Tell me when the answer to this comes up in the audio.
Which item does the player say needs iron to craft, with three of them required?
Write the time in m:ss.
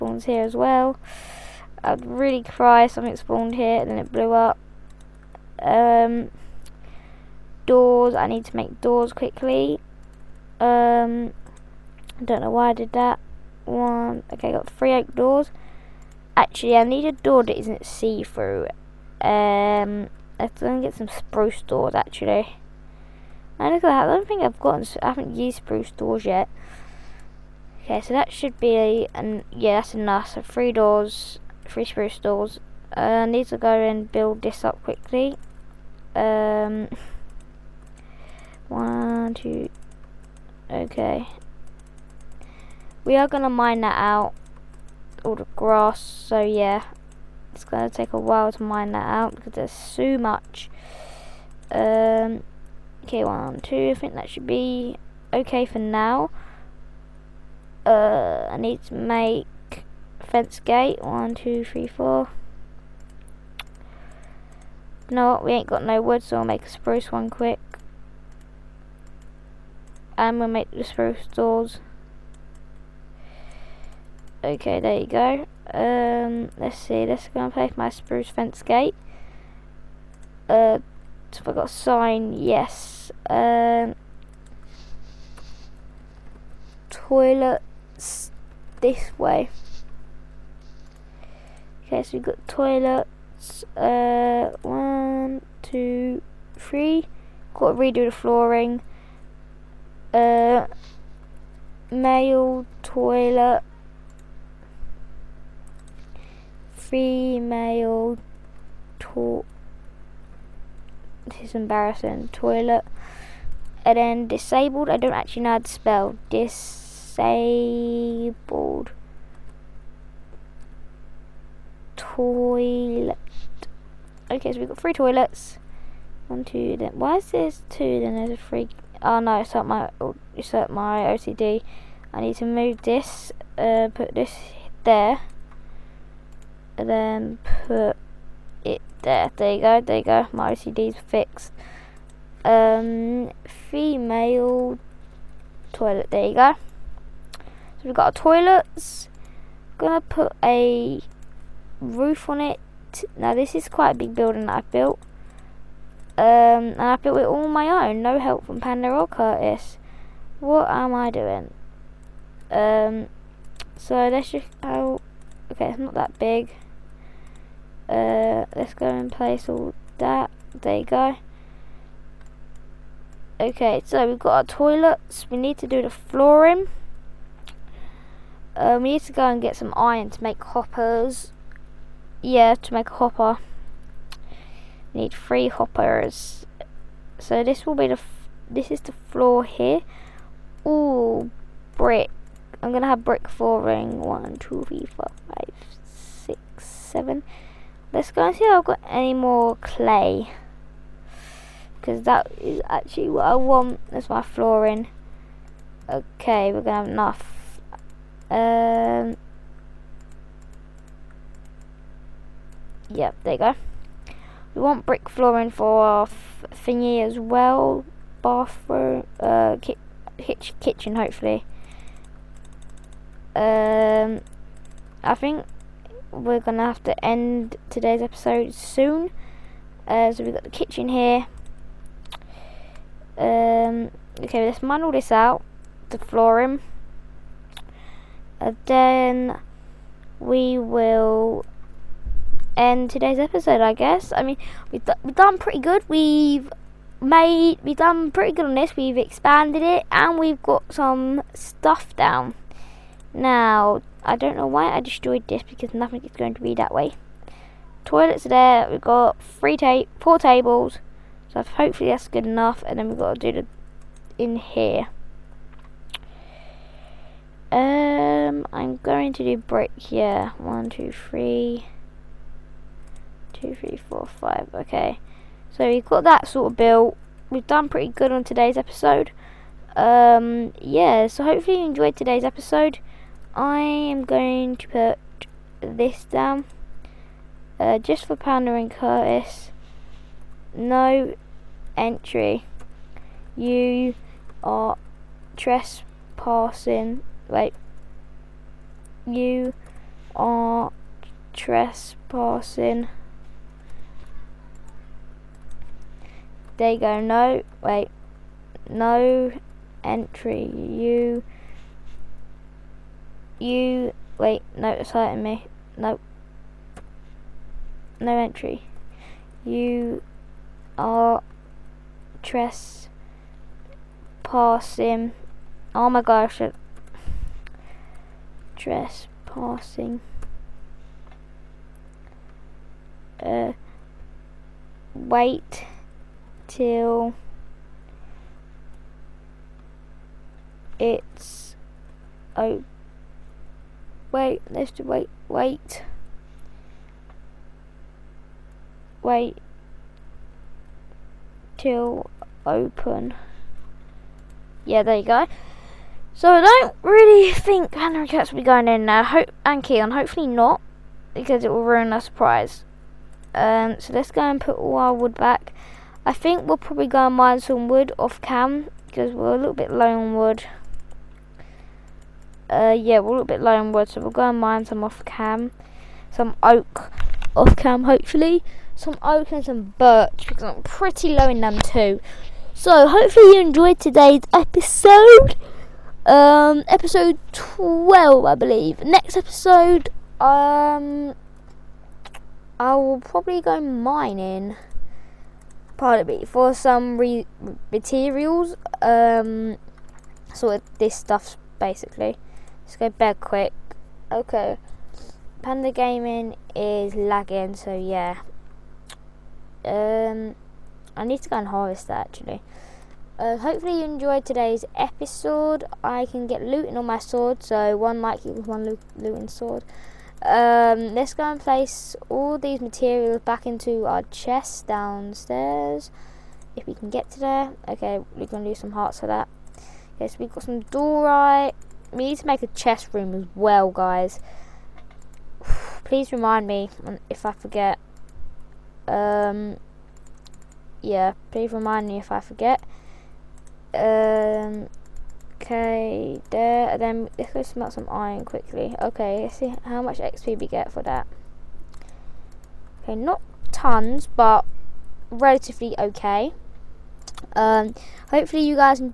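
3:02.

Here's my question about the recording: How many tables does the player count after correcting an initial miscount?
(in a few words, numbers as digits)
4.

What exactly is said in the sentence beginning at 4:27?
Um, I'm going to do brick.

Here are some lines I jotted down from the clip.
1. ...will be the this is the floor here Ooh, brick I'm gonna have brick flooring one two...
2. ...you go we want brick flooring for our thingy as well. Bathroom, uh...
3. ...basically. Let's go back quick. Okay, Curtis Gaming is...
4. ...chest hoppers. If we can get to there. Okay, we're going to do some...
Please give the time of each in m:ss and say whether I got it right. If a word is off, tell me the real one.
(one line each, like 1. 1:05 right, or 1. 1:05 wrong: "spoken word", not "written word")
1. 3:07 right
2. 3:33 right
3. 6:41 wrong: "Panda", not "Curtis"
4. 7:04 wrong: "downstairs", not "hoppers".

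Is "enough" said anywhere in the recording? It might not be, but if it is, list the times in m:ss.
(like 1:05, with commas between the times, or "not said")
0:29, 3:26, 4:22.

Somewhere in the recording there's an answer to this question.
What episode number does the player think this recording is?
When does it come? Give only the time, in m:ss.
6:26.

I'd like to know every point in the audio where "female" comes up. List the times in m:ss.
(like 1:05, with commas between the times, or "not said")
1:46, 2:23.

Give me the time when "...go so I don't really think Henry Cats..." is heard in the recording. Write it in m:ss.
5:55.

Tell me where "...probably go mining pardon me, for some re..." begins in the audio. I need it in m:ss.
6:33.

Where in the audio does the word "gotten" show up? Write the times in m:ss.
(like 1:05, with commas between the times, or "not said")
0:24.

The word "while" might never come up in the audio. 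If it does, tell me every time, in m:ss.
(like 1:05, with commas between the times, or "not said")
0:48.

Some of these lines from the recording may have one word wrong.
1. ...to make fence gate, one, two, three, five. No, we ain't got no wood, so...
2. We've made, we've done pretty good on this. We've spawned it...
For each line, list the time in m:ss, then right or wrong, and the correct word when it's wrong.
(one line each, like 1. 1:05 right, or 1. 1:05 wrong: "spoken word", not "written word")
1. 0:58 wrong: "four", not "five"
2. 4:05 wrong: "expanded", not "spawned".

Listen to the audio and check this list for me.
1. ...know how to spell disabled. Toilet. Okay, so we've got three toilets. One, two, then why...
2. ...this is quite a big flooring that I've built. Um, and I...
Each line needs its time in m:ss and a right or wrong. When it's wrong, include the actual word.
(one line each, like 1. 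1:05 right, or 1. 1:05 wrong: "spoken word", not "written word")
1. 1:55 right
2. 2:33 wrong: "building", not "flooring".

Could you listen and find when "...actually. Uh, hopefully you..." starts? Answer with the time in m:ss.
6:52.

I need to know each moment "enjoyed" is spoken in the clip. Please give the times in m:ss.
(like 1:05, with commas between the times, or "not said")
4:41, 6:23, 6:53.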